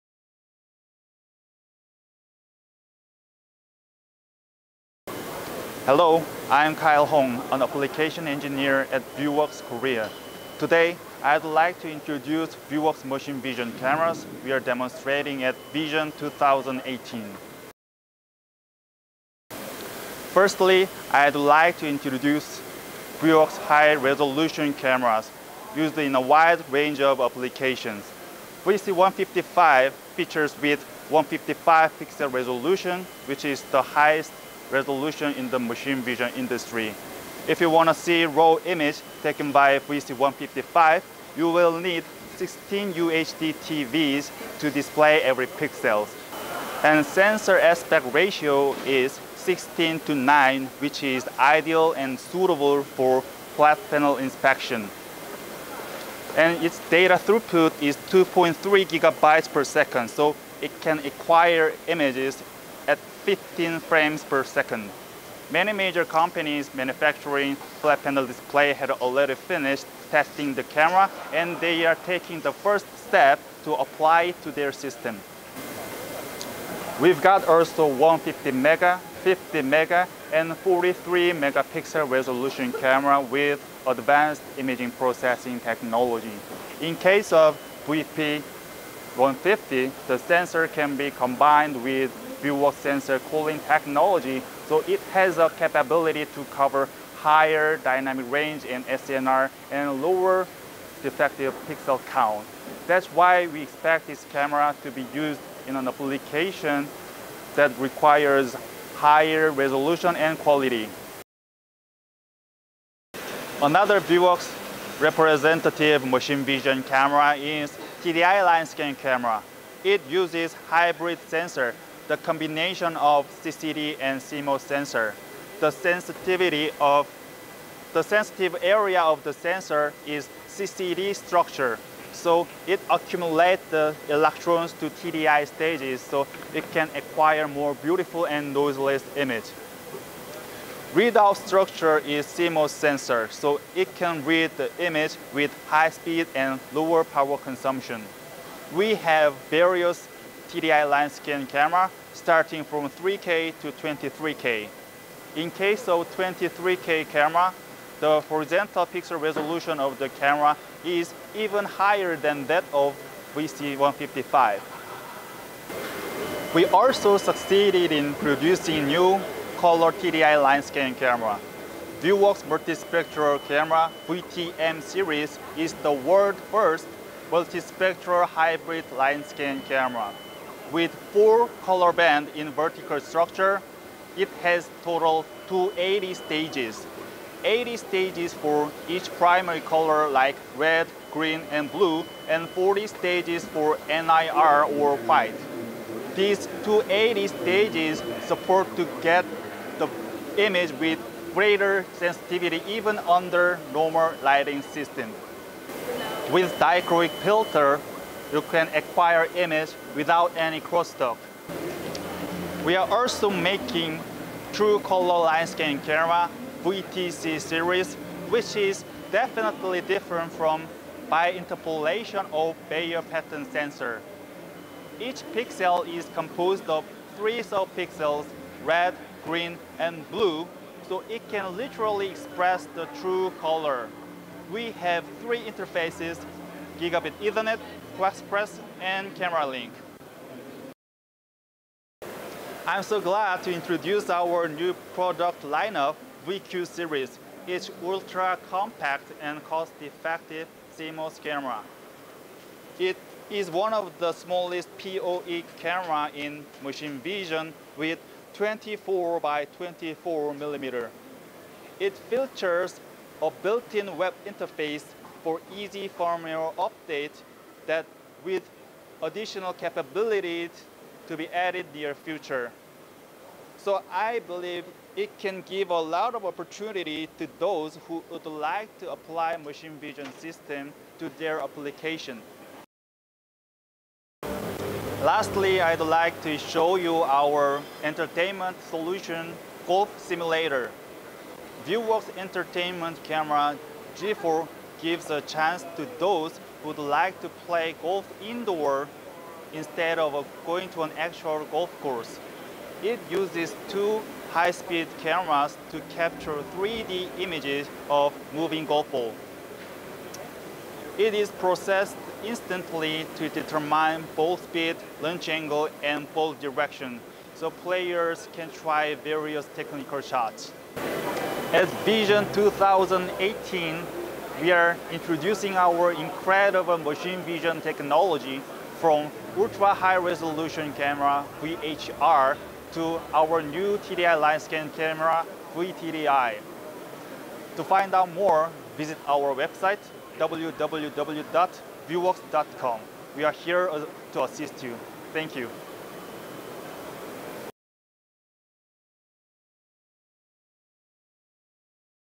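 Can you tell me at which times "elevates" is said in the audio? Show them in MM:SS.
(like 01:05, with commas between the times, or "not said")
not said.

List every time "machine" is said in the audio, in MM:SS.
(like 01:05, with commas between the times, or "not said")
00:13, 00:35, 01:56, 04:16, 04:39, 05:26.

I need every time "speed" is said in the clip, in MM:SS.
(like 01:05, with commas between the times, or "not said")
02:25, 05:04, 05:14.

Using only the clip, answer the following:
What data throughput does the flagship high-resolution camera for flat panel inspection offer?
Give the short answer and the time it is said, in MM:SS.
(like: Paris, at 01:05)
2.3 gigabytes per second, at 00:58.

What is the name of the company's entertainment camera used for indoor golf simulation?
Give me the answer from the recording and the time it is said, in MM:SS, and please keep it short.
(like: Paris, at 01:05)
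G4, at 04:53.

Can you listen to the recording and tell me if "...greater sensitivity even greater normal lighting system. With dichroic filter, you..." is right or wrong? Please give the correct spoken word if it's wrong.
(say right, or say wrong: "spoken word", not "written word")
wrong: "under", not "greater".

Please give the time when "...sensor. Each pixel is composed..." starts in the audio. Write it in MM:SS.
03:43.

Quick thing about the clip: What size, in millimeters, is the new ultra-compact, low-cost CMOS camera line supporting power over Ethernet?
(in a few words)
24 by 24 millimeters.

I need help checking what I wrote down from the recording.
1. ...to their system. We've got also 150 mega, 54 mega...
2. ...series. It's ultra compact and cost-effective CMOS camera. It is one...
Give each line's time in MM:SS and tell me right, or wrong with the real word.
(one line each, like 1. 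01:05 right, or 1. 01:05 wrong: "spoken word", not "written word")
1. 01:14 wrong: "50", not "54"
2. 04:06 right.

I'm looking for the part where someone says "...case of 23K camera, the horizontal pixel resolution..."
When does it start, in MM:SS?
02:35.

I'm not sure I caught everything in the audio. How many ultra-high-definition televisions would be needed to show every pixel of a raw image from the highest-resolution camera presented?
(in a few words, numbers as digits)
16.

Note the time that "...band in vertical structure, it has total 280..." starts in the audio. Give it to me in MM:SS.
03:01.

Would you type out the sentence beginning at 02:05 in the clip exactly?
The sensitivity of the sensitive area of the sensor is CCD structure.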